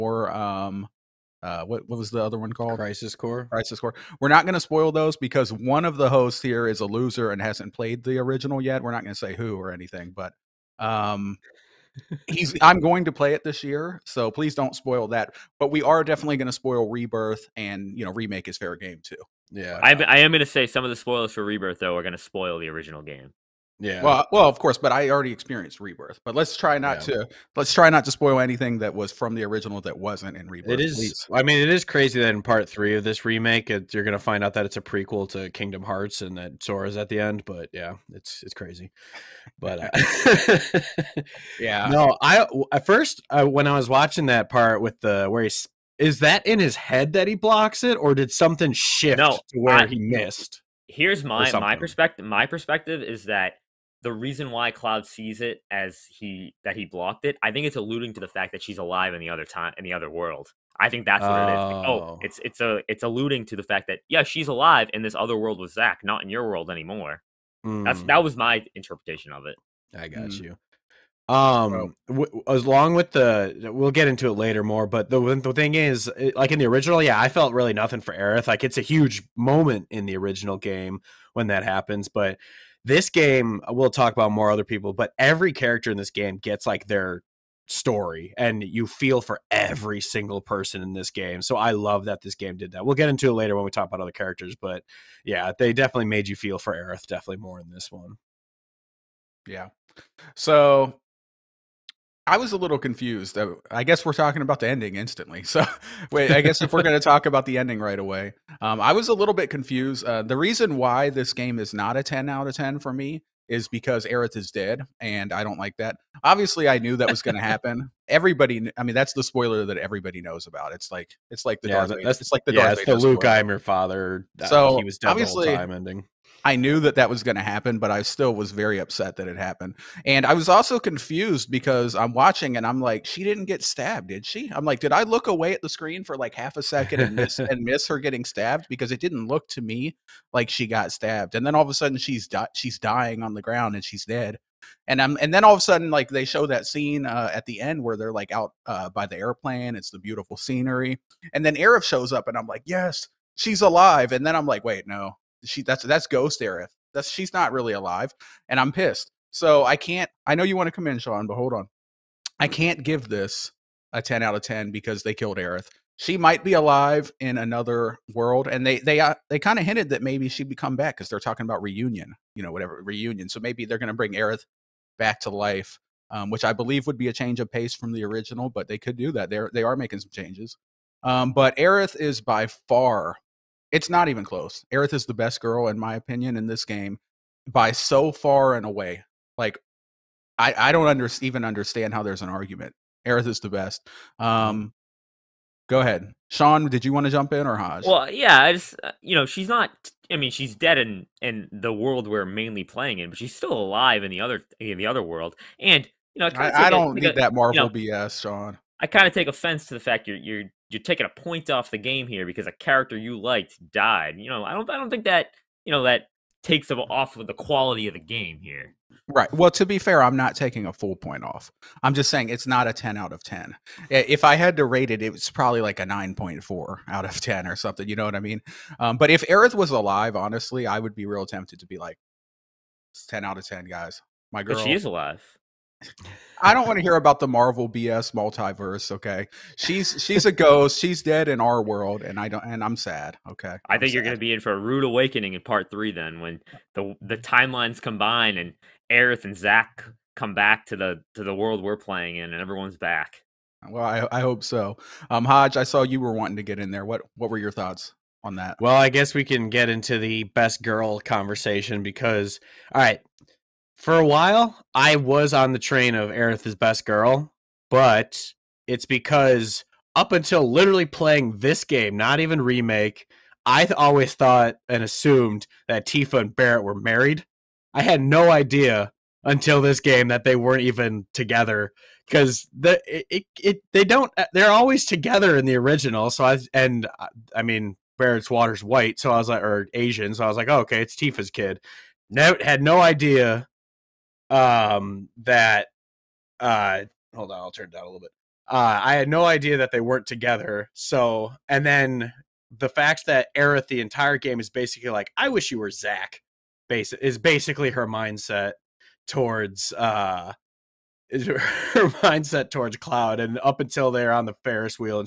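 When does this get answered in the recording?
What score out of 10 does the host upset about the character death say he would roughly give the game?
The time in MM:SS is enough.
03:45.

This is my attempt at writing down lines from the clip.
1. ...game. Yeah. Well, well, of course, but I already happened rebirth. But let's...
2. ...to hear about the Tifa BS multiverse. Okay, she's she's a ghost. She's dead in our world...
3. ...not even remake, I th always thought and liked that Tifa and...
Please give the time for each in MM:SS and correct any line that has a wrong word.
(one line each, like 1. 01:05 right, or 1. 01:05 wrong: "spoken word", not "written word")
1. 00:23 wrong: "experienced", not "happened"
2. 03:56 wrong: "Marvel", not "Tifa"
3. 04:31 wrong: "assumed", not "liked".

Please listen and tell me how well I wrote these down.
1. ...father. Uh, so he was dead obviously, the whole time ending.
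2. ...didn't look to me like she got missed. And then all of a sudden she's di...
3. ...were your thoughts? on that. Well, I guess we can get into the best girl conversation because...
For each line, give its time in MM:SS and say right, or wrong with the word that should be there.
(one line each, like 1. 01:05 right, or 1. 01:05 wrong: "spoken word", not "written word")
1. 02:03 right
2. 02:19 wrong: "stabbed", not "missed"
3. 04:17 right.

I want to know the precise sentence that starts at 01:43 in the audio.
I guess we're talking about the ending instantly.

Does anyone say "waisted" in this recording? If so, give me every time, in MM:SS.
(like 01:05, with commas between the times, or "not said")
not said.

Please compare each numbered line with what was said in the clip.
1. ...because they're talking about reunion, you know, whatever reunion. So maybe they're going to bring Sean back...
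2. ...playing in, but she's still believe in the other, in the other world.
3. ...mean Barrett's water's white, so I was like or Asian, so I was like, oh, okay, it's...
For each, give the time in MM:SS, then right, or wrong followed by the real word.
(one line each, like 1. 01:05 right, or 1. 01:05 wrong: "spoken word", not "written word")
1. 02:50 wrong: "Aerith", not "Sean"
2. 03:22 wrong: "alive", not "believe"
3. 04:47 right.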